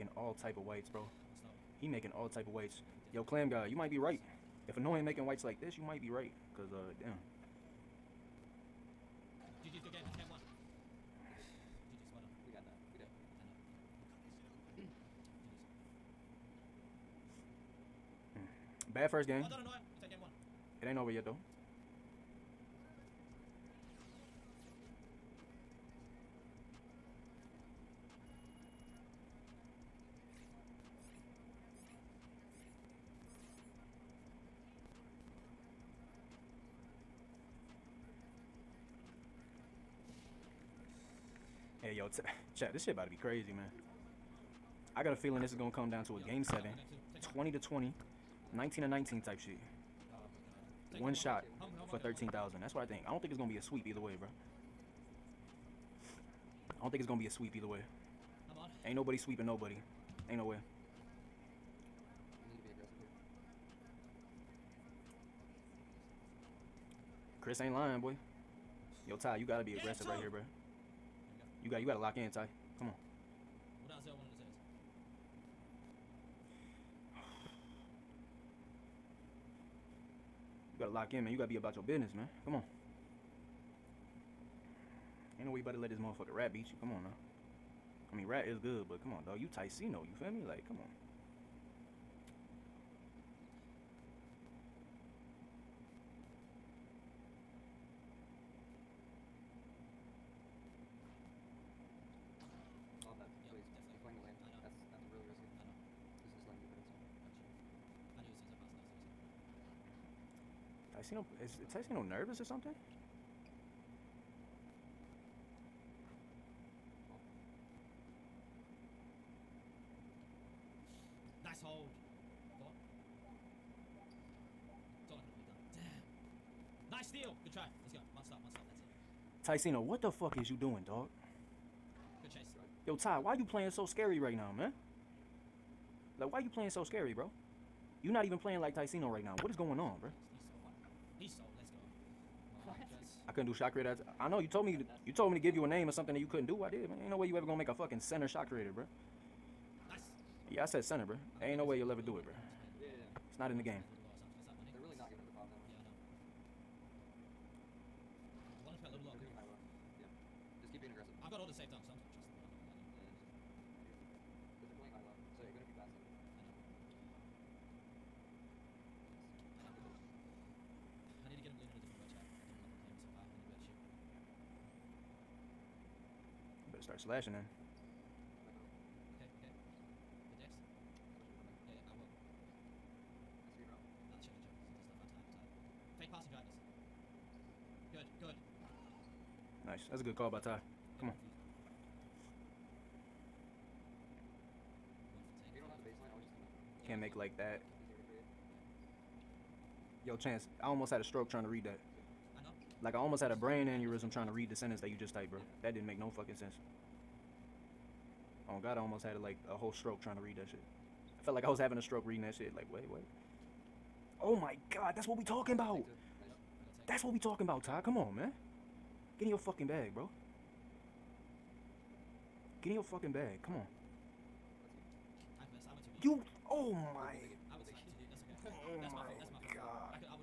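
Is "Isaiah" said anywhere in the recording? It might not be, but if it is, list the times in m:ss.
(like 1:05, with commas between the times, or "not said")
1:13.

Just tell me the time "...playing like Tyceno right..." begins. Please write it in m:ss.
2:18.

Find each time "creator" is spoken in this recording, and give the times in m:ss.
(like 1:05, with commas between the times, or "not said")
2:23, 2:28.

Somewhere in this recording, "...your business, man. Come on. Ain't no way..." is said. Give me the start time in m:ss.
1:21.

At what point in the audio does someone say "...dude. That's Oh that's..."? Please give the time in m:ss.
3:48.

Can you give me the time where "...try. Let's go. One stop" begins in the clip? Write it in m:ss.
2:07.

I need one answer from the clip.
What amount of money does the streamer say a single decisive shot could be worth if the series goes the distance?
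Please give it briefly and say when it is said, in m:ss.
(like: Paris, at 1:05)
13,000, at 0:51.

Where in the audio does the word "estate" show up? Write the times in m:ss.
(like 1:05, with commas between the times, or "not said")
not said.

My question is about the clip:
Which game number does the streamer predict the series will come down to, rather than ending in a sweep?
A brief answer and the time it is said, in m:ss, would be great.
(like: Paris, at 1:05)
game seven, at 0:46.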